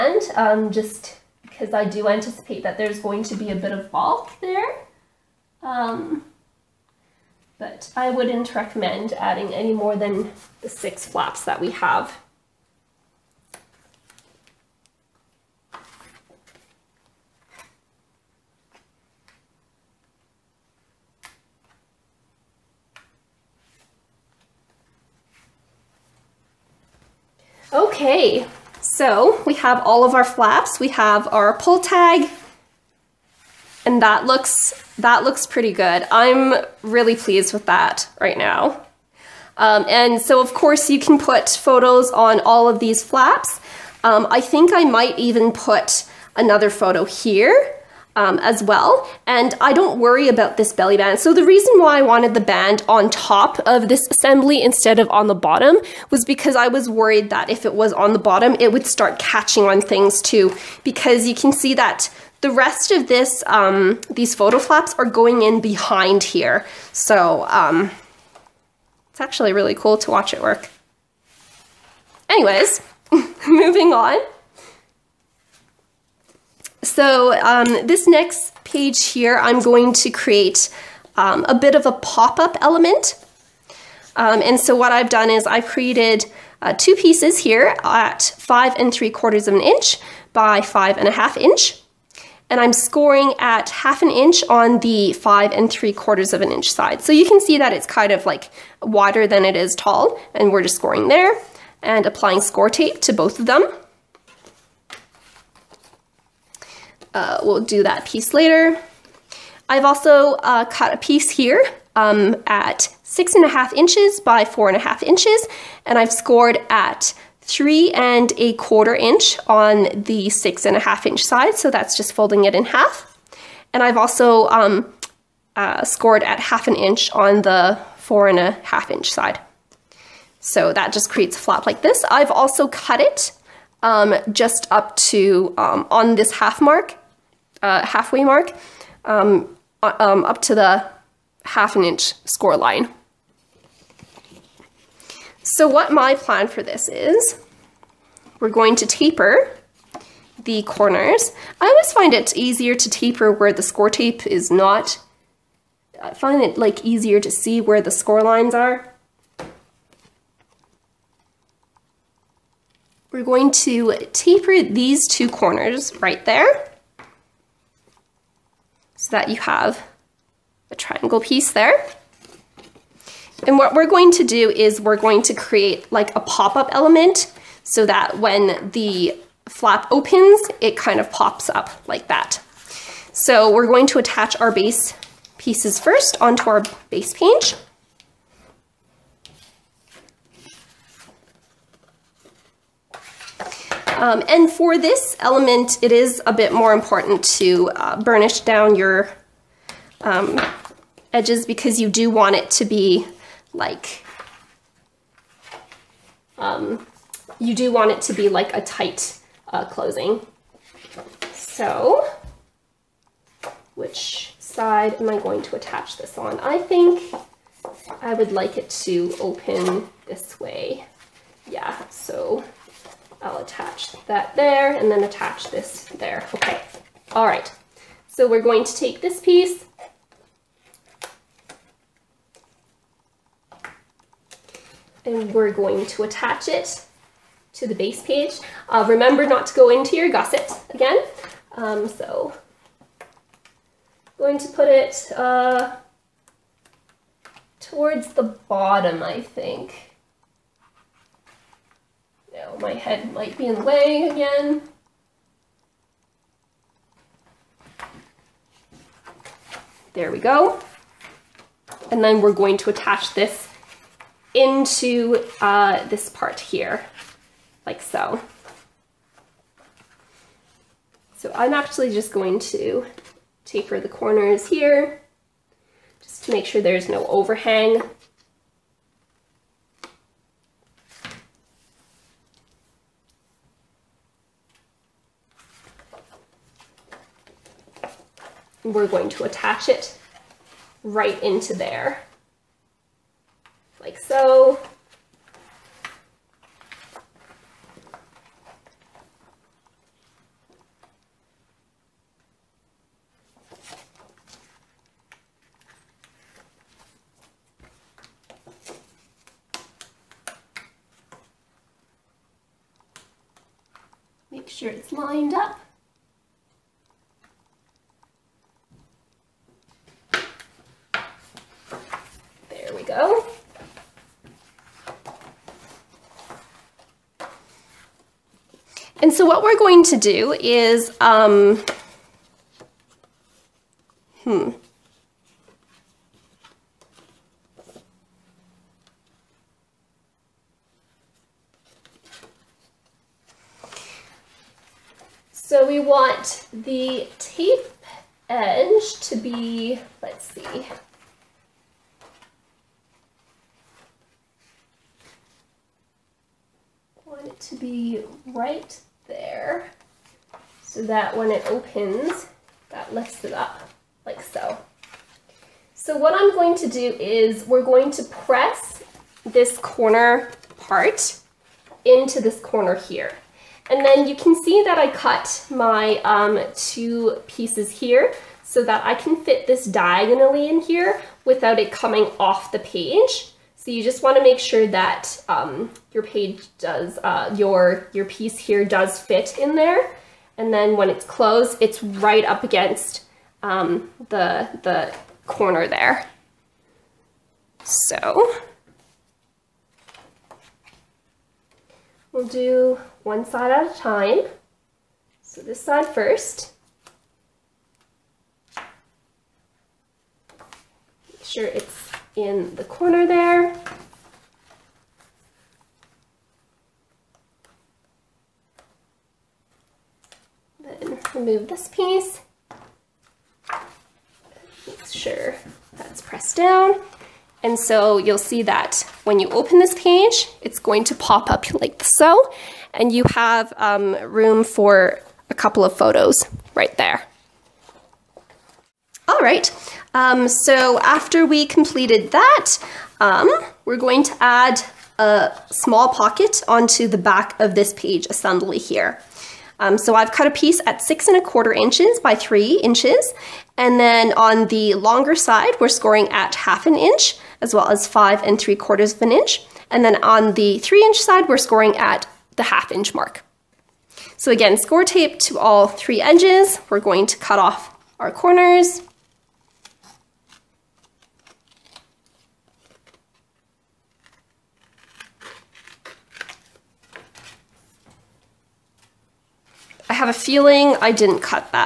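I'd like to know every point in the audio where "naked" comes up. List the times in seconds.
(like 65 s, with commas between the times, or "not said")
not said.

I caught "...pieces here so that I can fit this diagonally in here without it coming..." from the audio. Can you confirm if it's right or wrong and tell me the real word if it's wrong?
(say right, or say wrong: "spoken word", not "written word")
right.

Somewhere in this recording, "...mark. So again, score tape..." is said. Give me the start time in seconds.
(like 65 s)
462 s.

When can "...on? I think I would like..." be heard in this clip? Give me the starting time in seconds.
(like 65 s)
216 s.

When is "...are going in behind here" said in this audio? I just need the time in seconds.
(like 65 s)
64 s.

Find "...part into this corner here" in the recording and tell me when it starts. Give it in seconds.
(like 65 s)
370 s.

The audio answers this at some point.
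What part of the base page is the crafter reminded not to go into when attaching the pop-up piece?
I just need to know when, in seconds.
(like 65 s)
240 s.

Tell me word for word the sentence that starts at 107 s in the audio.
uh, we'll do that piece later.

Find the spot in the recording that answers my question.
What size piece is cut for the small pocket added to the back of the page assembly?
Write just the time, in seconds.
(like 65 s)
450 s.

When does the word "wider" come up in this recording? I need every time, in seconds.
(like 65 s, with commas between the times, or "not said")
98 s.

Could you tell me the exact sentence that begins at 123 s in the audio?
And I've also um, uh, scored at half an inch on the four and a half inch side.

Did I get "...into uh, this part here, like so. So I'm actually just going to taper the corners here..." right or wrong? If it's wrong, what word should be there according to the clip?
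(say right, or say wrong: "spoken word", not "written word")
right.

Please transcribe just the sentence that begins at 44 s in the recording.
Um, I think I might even put another photo here um, as well.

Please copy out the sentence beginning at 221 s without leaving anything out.
Yeah, so I'll attach that there and then attach this there.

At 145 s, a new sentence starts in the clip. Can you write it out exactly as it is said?
So what my plan for this is, we're going to taper the corners.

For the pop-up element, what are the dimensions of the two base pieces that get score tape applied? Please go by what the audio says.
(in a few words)
5 3/4 by 5 1/2 inches.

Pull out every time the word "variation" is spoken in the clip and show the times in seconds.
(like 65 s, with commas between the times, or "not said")
not said.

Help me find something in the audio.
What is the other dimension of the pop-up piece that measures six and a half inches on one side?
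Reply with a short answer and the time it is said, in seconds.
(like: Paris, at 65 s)
4 1/2 inches, at 114 s.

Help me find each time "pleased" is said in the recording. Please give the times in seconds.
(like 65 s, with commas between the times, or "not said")
37 s.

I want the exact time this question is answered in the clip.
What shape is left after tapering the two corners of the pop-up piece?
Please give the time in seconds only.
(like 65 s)
170 s.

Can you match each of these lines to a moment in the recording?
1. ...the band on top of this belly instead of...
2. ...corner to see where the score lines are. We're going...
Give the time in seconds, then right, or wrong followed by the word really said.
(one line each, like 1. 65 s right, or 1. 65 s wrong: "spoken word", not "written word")
1. 52 s wrong: "assembly", not "belly"
2. 156 s wrong: "easier", not "corner".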